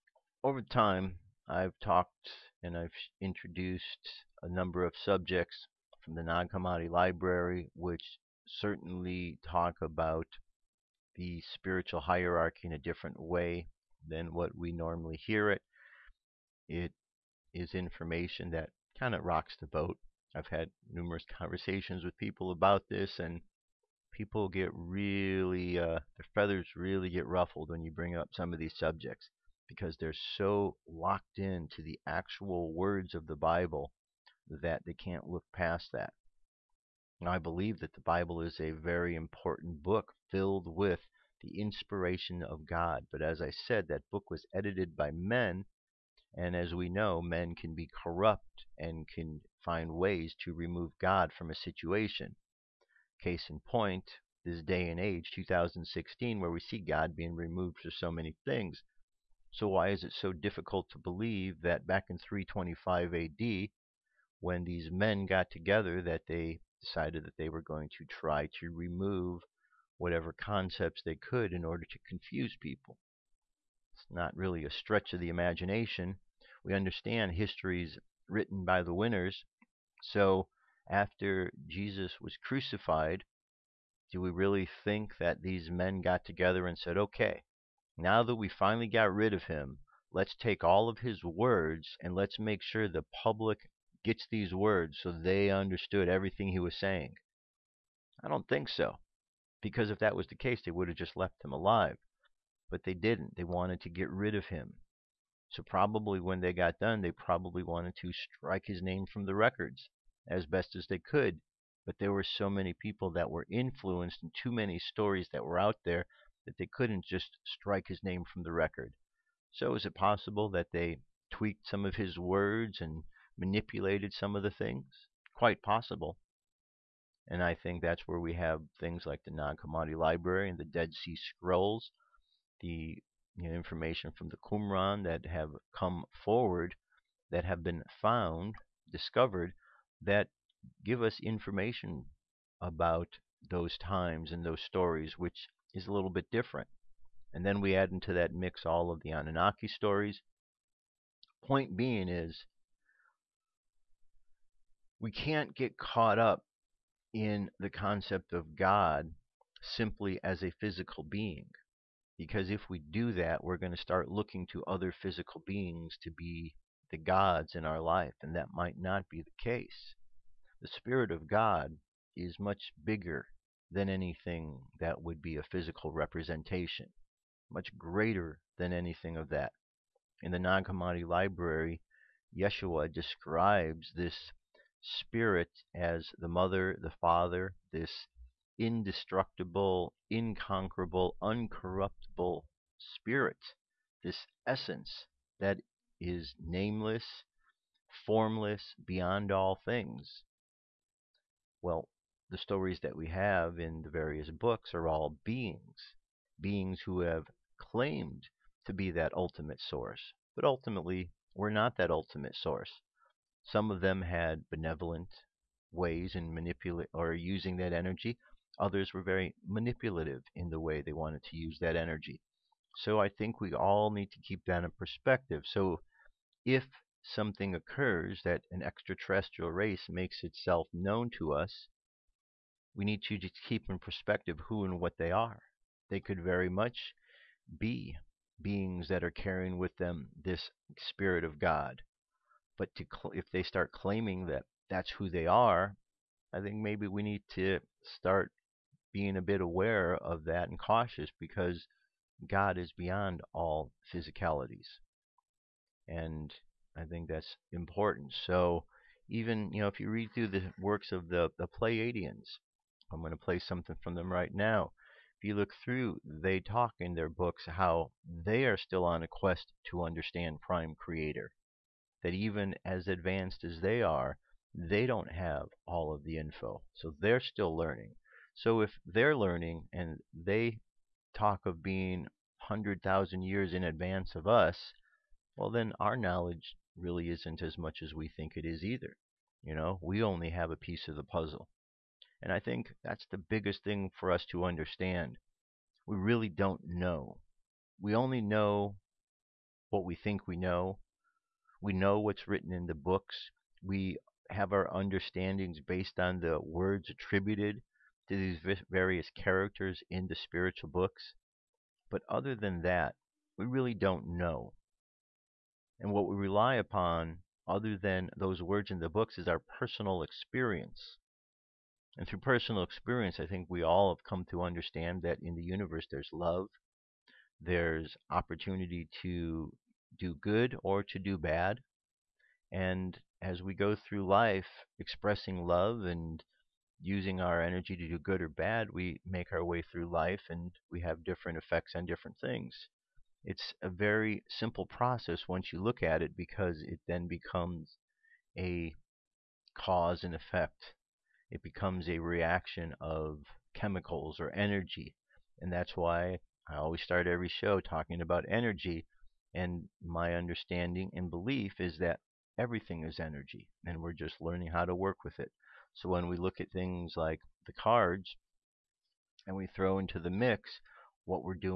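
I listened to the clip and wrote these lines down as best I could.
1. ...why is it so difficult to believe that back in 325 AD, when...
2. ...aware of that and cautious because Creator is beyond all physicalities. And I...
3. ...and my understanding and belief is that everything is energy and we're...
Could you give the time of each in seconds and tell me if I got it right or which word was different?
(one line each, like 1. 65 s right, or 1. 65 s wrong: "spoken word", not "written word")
1. 59 s right
2. 249 s wrong: "God", not "Creator"
3. 359 s right.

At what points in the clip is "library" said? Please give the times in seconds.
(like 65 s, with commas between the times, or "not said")
6 s, 129 s, 181 s.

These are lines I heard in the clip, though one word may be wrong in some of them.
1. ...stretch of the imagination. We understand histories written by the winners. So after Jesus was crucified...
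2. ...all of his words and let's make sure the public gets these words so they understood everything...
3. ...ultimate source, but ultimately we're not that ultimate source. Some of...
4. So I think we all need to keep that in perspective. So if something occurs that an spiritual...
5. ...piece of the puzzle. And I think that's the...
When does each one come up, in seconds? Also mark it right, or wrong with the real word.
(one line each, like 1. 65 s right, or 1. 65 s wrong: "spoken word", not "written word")
1. 74 s right
2. 90 s right
3. 209 s right
4. 222 s wrong: "extraterrestrial", not "spiritual"
5. 290 s right.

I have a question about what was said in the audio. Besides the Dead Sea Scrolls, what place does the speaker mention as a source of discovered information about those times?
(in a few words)
Qumran.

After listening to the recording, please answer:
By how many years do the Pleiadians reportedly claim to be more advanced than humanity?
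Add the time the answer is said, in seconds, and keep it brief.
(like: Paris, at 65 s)
100,000 years, at 282 s.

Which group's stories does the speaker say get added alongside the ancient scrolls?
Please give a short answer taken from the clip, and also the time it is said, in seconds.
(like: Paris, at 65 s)
Anunnaki, at 149 s.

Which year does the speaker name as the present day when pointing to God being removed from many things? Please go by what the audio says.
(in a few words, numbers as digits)
2016.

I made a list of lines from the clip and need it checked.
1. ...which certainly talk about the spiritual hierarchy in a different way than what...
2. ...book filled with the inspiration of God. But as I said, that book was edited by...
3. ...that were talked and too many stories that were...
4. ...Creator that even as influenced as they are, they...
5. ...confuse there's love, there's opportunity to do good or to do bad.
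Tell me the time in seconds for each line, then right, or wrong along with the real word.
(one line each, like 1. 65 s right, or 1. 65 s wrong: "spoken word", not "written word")
1. 7 s right
2. 39 s right
3. 113 s wrong: "influenced", not "talked"
4. 270 s wrong: "advanced", not "influenced"
5. 325 s wrong: "universe", not "confuse".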